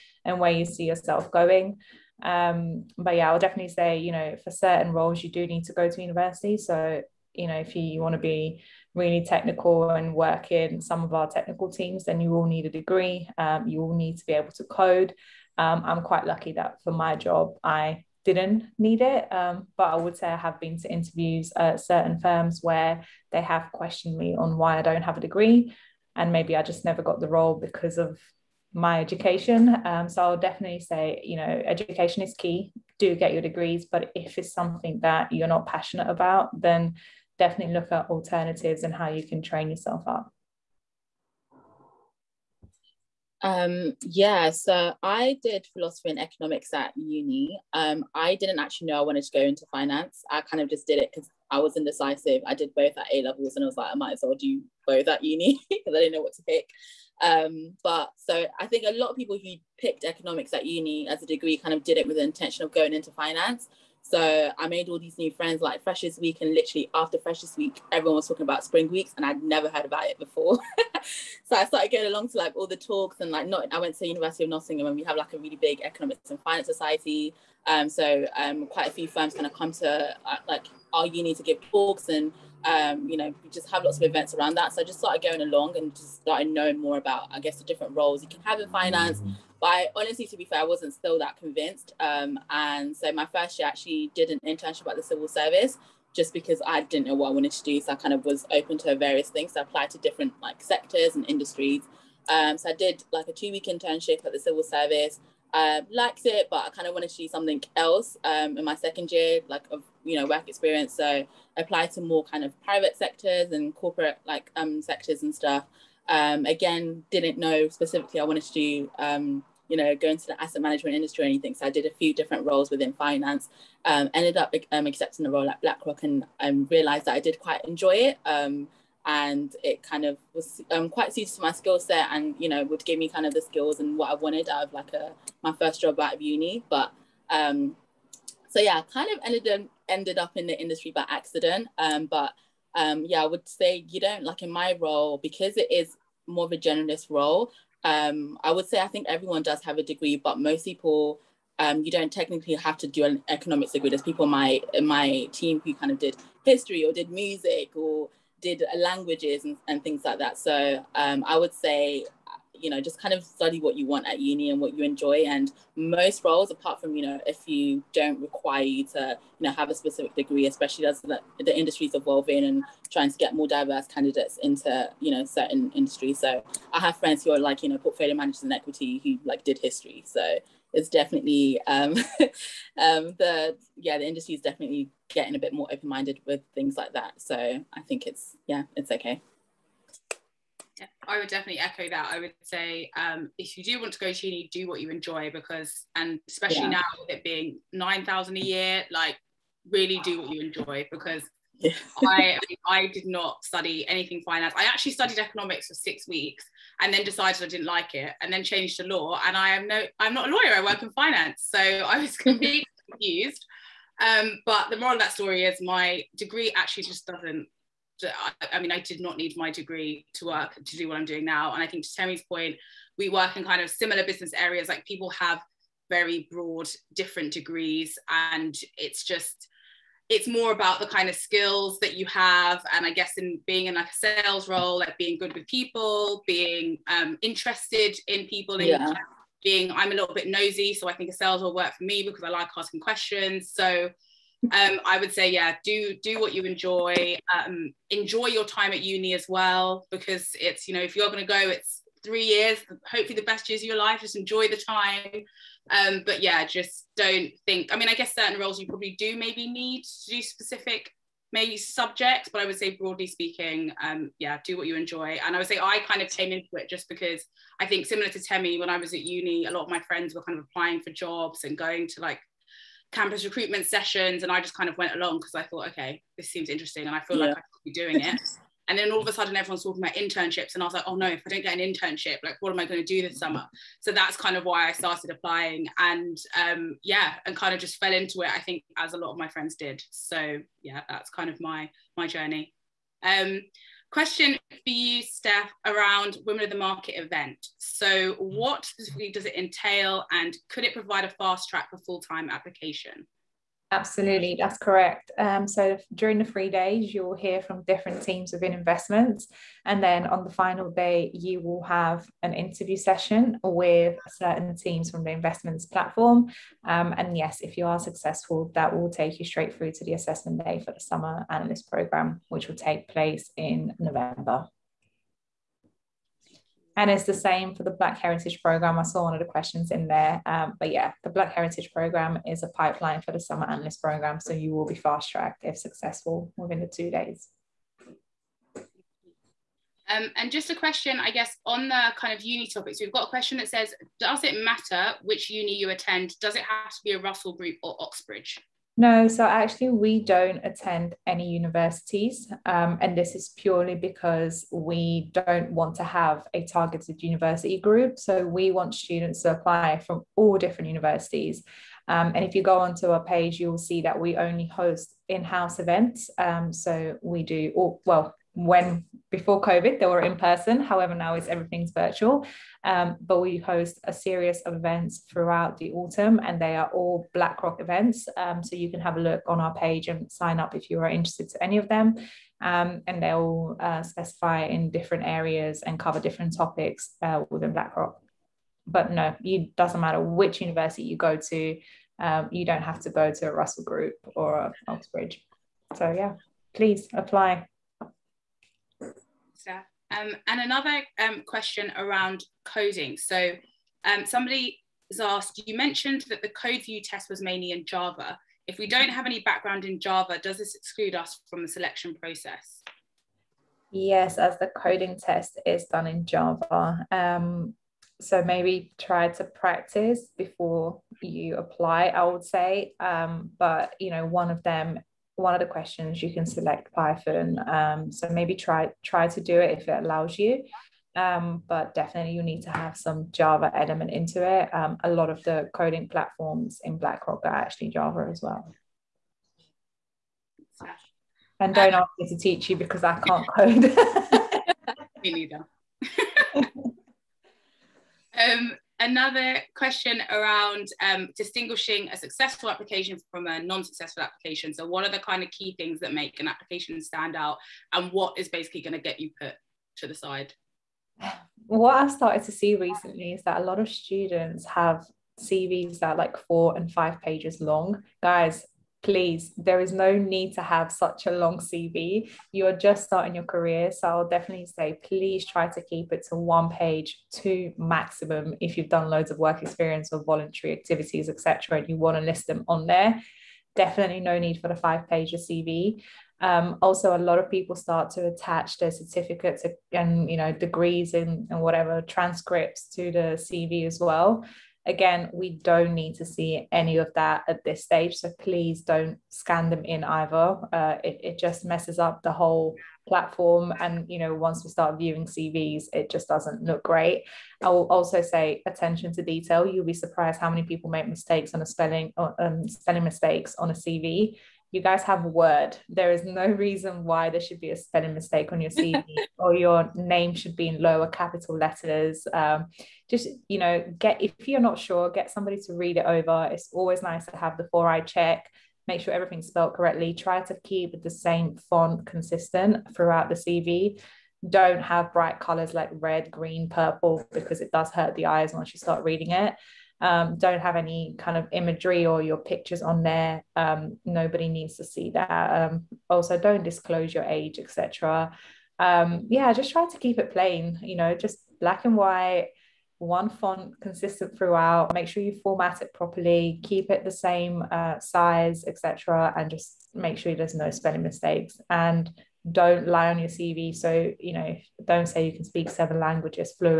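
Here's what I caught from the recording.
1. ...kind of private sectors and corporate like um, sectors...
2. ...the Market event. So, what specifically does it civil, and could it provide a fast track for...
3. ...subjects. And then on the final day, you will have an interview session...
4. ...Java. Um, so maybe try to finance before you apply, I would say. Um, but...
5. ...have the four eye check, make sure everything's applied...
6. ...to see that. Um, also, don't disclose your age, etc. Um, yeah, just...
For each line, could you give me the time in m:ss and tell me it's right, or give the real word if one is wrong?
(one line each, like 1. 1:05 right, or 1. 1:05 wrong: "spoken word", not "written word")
1. 1:52 right
2. 4:56 wrong: "entail", not "civil"
3. 5:08 wrong: "investments", not "subjects"
4. 6:56 wrong: "practice", not "finance"
5. 8:47 wrong: "spelled", not "applied"
6. 9:04 right.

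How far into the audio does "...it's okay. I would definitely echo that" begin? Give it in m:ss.
3:08.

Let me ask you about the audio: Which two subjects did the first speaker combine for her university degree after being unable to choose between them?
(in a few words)
Philosophy and economics.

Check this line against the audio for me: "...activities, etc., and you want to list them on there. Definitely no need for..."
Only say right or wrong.
right.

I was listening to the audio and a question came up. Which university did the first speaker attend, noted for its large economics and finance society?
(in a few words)
University of Nottingham.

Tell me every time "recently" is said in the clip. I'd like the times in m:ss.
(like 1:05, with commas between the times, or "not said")
7:42.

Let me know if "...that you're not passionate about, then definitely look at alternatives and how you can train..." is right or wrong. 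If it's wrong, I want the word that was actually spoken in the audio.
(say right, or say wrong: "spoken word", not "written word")
right.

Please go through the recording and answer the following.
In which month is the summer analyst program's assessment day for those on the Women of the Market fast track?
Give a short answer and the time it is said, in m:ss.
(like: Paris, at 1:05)
November, at 5:23.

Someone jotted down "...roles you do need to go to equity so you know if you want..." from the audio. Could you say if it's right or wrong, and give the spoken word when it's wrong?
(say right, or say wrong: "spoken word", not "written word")
wrong: "university", not "equity".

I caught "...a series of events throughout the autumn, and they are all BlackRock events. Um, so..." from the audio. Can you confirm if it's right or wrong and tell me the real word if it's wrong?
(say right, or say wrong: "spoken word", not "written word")
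right.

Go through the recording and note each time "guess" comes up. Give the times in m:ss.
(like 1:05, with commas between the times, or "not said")
1:27, 3:52, 4:17, 5:41.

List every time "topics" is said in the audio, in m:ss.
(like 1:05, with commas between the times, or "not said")
5:42, 6:26.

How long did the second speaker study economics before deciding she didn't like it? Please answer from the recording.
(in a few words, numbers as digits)
6 weeks.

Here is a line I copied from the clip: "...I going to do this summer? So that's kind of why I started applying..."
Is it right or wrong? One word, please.
right.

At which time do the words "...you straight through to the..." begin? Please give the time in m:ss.
5:19.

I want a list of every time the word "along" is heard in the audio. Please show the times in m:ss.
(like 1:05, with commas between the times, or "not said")
1:12, 1:25, 4:34.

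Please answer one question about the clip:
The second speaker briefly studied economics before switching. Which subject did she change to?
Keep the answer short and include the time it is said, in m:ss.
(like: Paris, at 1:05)
Law, at 3:28.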